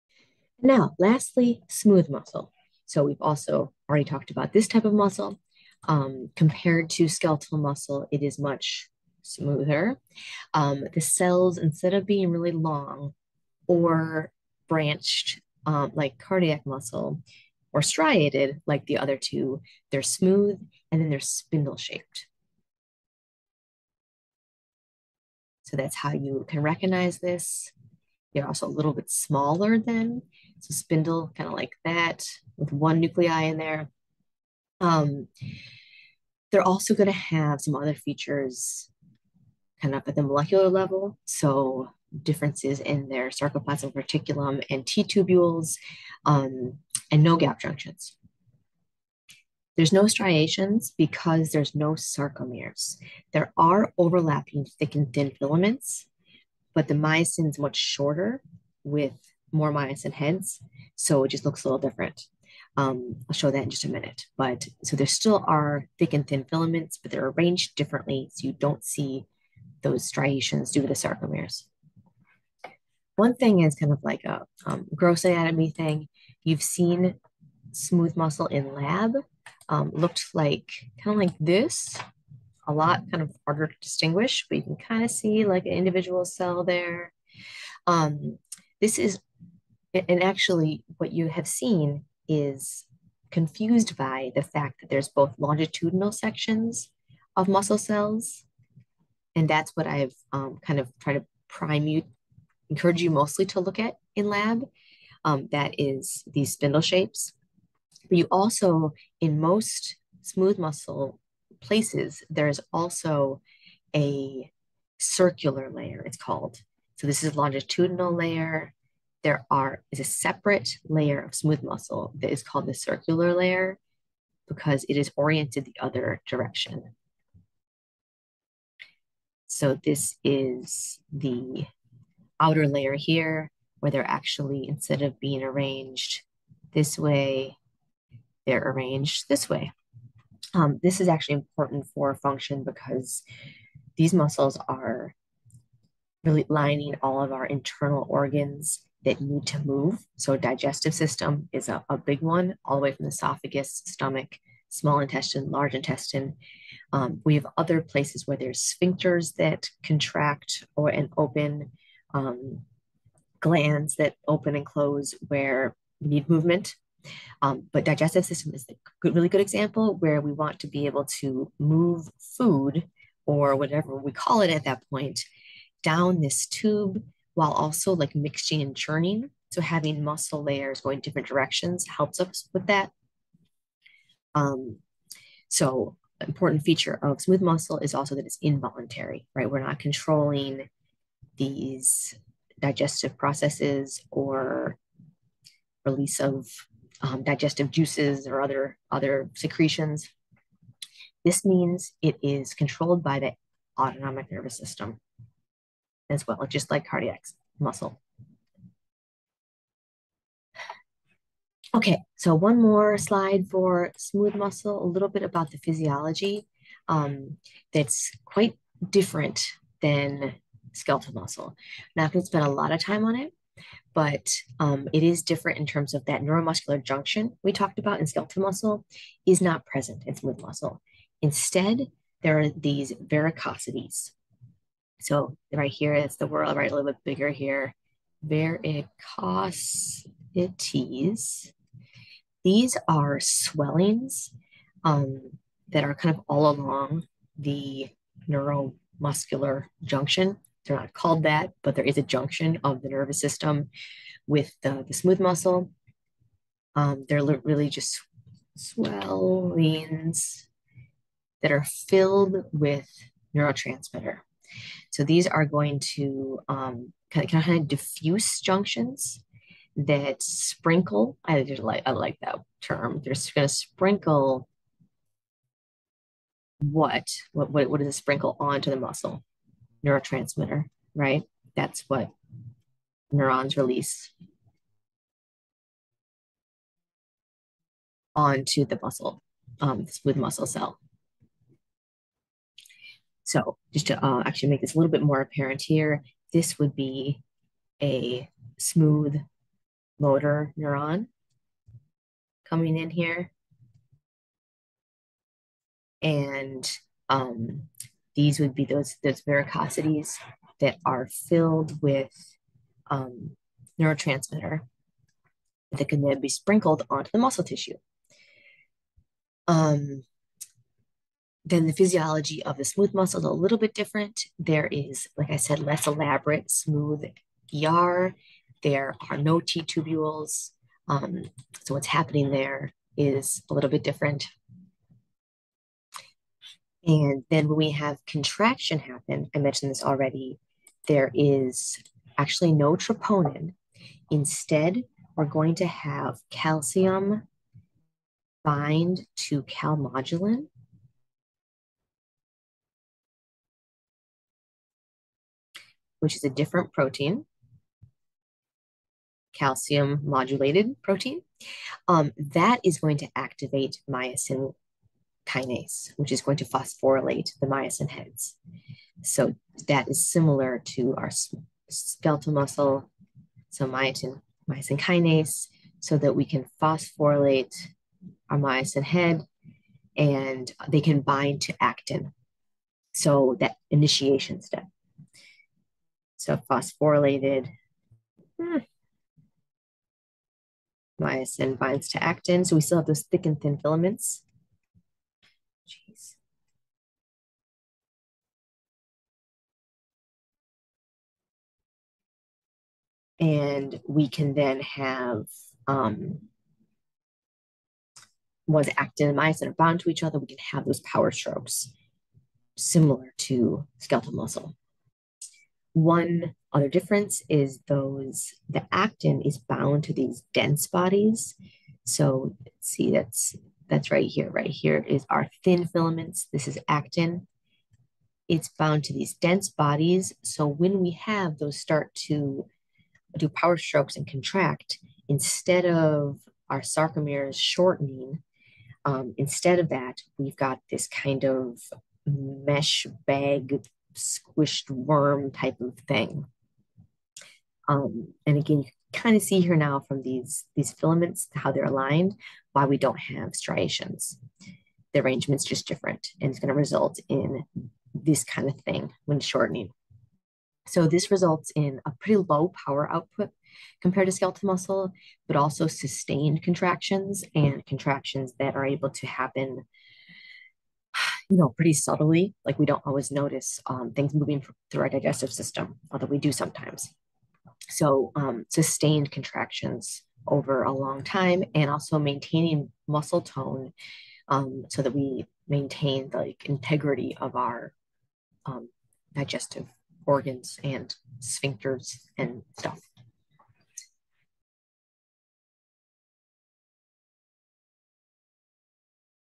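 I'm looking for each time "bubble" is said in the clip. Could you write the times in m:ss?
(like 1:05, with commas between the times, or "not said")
not said.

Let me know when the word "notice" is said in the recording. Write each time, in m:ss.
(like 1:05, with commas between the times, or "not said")
7:53.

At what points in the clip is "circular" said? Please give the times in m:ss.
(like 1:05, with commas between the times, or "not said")
1:54, 2:02.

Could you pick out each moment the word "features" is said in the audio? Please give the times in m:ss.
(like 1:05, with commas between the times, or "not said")
0:37, 3:06.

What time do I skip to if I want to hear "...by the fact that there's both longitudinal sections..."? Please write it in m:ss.
1:33.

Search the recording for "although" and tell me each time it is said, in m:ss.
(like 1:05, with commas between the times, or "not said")
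7:55.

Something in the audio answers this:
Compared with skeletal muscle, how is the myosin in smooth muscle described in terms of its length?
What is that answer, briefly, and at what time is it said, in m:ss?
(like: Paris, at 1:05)
Much shorter, at 0:57.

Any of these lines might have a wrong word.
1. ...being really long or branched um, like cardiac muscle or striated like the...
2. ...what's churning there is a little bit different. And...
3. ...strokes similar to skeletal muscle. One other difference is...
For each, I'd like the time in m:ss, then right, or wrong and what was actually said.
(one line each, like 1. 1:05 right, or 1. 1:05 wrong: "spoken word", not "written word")
1. 0:12 right
2. 5:31 wrong: "happening", not "churning"
3. 6:51 right.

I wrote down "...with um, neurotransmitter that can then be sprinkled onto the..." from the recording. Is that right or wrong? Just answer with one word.
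right.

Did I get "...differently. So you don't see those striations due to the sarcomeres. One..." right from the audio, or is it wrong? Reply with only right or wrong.
right.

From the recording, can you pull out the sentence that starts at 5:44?
Instead, we're going to have calcium bind to calmodulin.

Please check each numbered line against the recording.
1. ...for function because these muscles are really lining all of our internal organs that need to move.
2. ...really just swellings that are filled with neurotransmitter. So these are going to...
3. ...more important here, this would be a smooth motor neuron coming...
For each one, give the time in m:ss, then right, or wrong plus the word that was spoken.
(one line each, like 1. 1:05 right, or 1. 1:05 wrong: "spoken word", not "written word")
1. 2:21 right
2. 4:17 right
3. 4:55 wrong: "apparent", not "important".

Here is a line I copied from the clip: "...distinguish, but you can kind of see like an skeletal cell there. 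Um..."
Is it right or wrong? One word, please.
wrong.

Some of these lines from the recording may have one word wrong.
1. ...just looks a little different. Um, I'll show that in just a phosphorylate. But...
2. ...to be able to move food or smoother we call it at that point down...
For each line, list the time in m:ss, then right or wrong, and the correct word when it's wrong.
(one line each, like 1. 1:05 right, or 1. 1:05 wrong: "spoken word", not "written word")
1. 1:01 wrong: "minute", not "phosphorylate"
2. 2:50 wrong: "whatever", not "smoother".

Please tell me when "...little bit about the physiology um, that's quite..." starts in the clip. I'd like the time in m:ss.
3:34.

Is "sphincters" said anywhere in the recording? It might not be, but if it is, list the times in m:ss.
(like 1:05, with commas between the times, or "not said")
2:38, 8:11.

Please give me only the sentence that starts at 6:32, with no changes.
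So we still have those thick and thin filaments.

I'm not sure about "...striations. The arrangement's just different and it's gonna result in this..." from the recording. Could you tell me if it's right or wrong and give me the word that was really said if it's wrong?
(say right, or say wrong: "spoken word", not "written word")
right.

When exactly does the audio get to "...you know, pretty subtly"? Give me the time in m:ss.
7:51.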